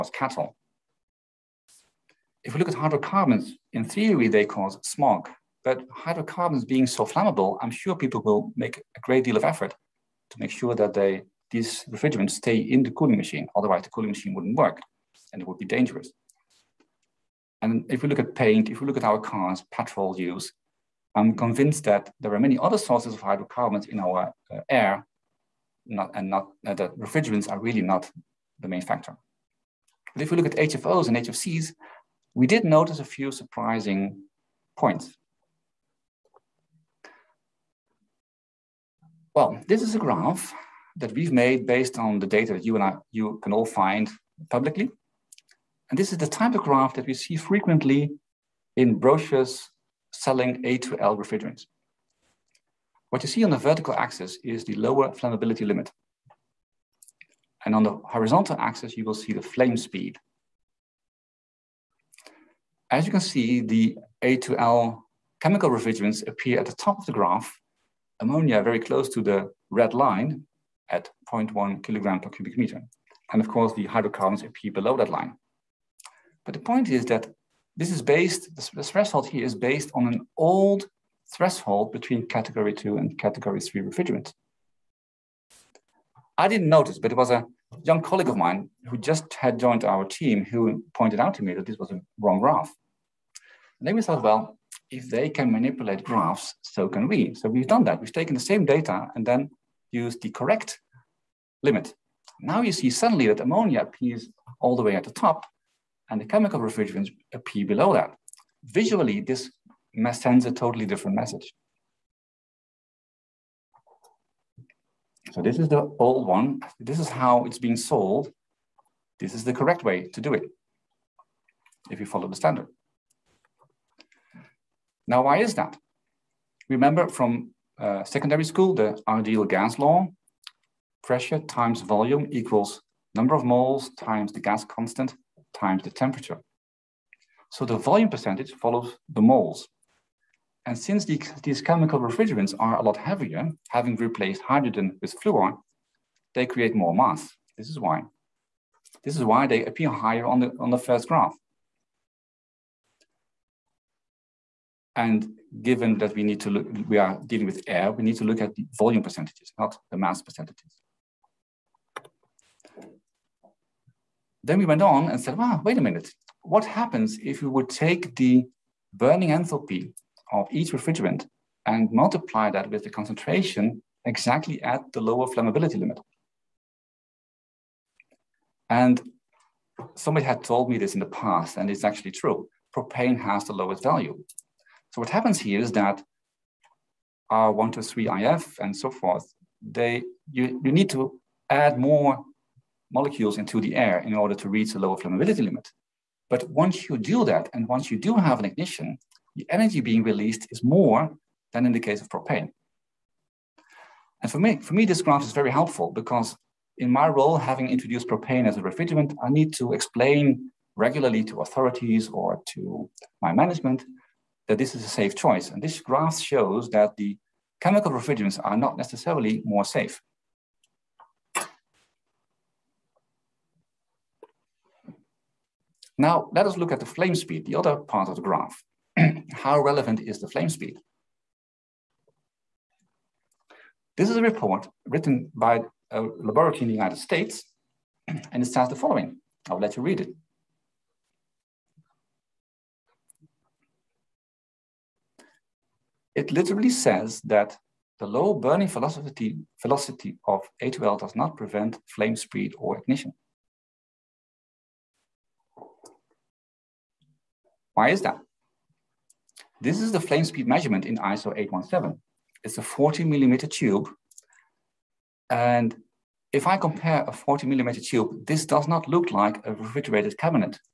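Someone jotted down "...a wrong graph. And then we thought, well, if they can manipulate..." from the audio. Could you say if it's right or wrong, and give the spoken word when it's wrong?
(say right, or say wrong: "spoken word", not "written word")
right.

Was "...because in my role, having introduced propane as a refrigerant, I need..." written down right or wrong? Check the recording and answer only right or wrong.
right.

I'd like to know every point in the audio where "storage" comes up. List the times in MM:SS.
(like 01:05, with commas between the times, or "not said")
not said.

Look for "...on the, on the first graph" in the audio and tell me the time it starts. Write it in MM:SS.
02:30.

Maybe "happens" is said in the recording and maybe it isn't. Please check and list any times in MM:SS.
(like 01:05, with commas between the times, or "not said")
02:46, 03:05.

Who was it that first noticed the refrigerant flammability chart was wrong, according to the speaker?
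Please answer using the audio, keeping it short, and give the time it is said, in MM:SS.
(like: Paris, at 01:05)
A young colleague, at 01:27.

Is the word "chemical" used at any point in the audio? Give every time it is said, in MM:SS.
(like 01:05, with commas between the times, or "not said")
01:05, 01:46, 02:21, 03:37.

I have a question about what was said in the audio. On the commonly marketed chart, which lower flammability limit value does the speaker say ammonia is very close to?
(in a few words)
0.1 kg per cubic meter.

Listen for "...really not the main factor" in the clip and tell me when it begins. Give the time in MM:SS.
00:27.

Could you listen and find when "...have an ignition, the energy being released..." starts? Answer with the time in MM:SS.
03:18.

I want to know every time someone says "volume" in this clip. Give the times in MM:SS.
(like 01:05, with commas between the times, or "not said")
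02:11, 02:17, 02:38.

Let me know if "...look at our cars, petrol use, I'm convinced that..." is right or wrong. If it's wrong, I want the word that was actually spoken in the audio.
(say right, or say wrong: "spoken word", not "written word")
right.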